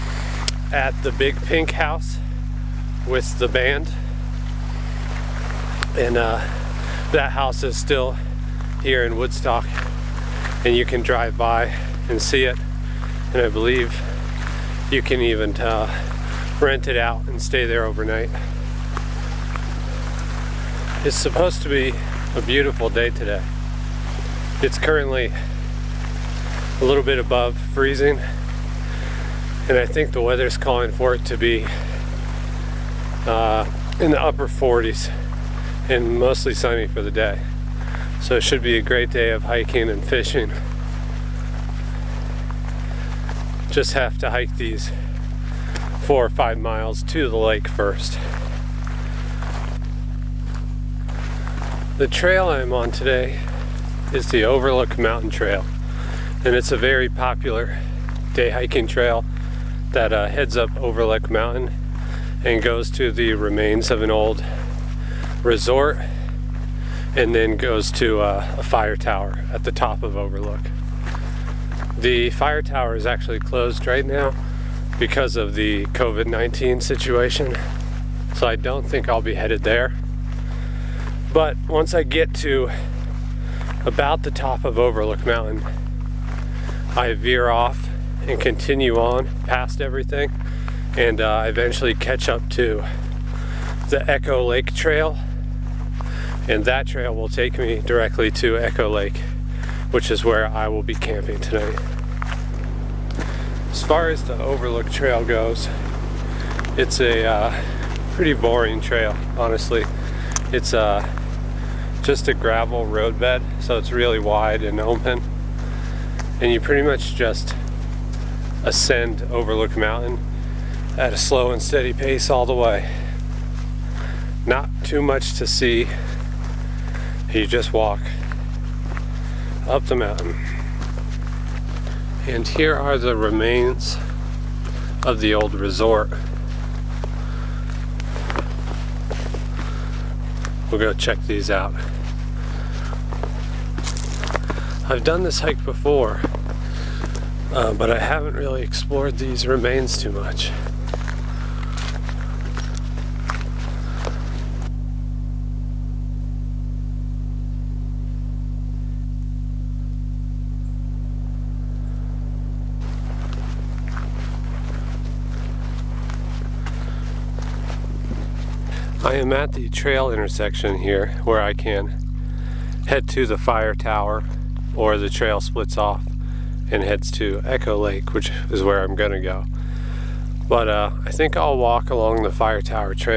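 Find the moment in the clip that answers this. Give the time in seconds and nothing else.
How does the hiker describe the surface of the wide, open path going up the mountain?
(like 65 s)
112 s.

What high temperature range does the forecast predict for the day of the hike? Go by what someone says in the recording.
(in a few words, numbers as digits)
upper 40s.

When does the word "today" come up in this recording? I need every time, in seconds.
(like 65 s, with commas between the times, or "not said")
23 s, 52 s.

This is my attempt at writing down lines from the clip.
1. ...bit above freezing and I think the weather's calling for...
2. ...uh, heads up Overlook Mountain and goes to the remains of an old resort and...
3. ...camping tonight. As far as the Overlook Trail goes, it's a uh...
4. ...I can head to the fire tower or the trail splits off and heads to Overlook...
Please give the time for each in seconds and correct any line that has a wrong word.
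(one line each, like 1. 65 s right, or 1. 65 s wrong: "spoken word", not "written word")
1. 27 s right
2. 60 s right
3. 100 s right
4. 171 s wrong: "Echo", not "Overlook".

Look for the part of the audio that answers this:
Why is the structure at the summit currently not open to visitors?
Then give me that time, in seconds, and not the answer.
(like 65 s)
75 s.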